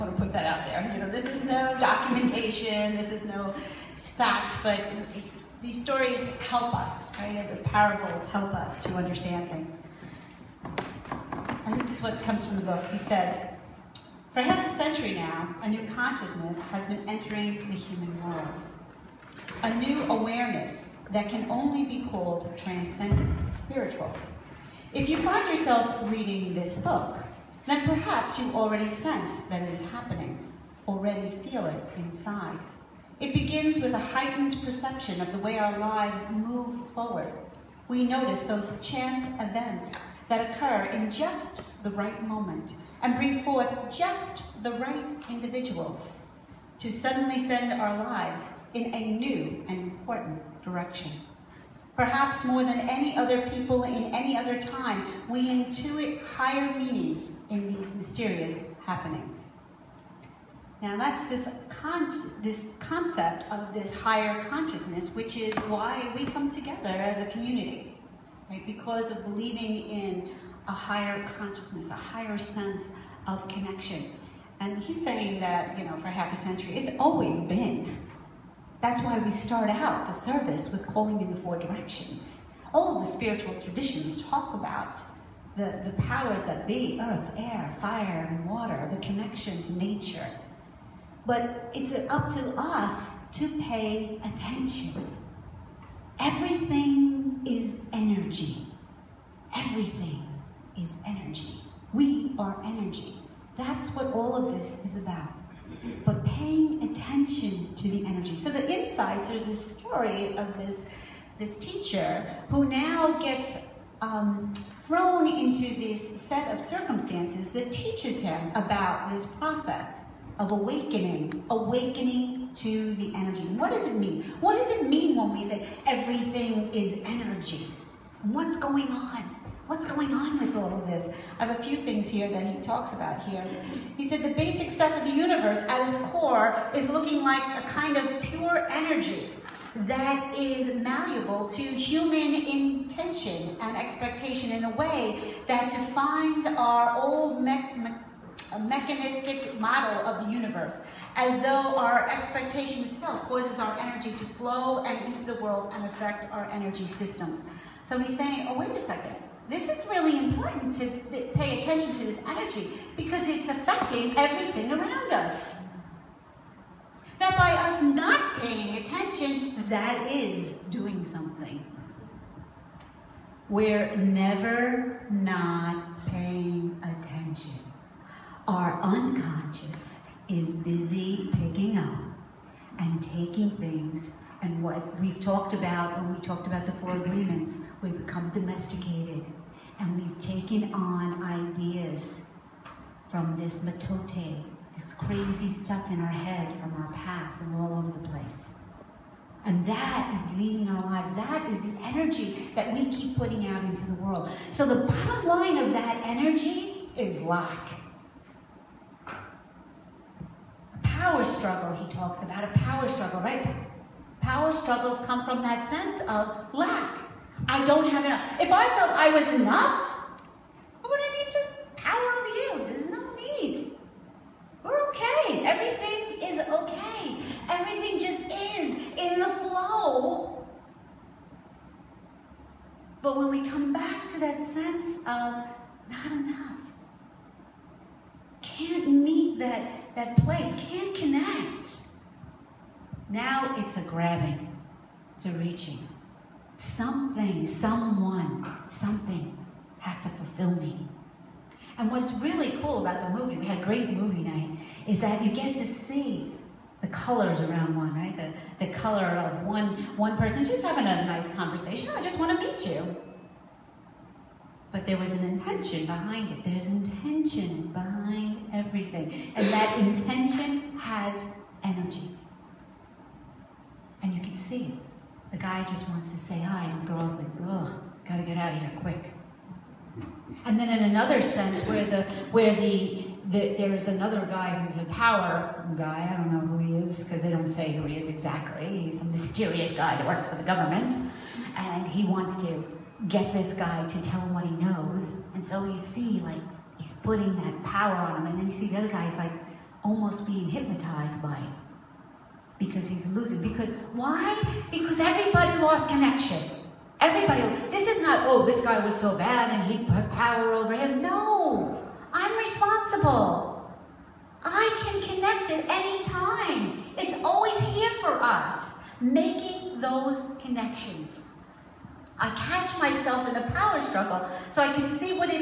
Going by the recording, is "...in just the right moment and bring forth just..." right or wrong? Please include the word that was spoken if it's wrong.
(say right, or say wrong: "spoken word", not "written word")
right.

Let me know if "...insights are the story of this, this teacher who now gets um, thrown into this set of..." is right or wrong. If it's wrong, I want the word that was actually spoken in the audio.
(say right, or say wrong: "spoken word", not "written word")
right.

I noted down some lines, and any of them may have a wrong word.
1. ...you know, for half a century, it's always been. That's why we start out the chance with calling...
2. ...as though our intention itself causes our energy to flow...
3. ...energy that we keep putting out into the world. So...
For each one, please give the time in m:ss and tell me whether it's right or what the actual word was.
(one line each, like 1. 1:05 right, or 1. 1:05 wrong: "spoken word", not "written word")
1. 1:15 wrong: "service", not "chance"
2. 2:31 wrong: "expectation", not "intention"
3. 3:21 right.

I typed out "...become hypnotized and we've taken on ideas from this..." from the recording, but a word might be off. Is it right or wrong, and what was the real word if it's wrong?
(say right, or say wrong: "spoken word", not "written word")
wrong: "domesticated", not "hypnotized".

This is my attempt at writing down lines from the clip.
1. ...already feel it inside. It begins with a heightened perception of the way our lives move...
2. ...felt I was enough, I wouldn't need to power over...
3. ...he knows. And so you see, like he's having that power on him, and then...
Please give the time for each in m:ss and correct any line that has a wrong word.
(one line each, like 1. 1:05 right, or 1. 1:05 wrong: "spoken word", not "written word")
1. 0:30 right
2. 3:38 right
3. 4:54 wrong: "putting", not "having".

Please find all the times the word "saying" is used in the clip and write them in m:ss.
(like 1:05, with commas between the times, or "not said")
1:15, 2:38.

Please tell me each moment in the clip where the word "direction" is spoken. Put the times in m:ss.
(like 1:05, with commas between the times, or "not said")
0:50, 1:21.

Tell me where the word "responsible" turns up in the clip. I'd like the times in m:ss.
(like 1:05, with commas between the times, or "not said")
5:12.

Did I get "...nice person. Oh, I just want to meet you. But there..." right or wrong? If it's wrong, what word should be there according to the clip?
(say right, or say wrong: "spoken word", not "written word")
wrong: "conversation", not "person".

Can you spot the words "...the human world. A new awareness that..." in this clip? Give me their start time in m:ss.
0:17.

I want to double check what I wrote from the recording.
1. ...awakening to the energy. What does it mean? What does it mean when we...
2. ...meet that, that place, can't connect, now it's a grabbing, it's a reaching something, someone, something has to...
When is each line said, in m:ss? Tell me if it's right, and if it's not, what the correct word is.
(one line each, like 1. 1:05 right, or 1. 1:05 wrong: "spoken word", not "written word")
1. 2:01 right
2. 3:58 right.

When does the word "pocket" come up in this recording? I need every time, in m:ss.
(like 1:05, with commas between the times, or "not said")
not said.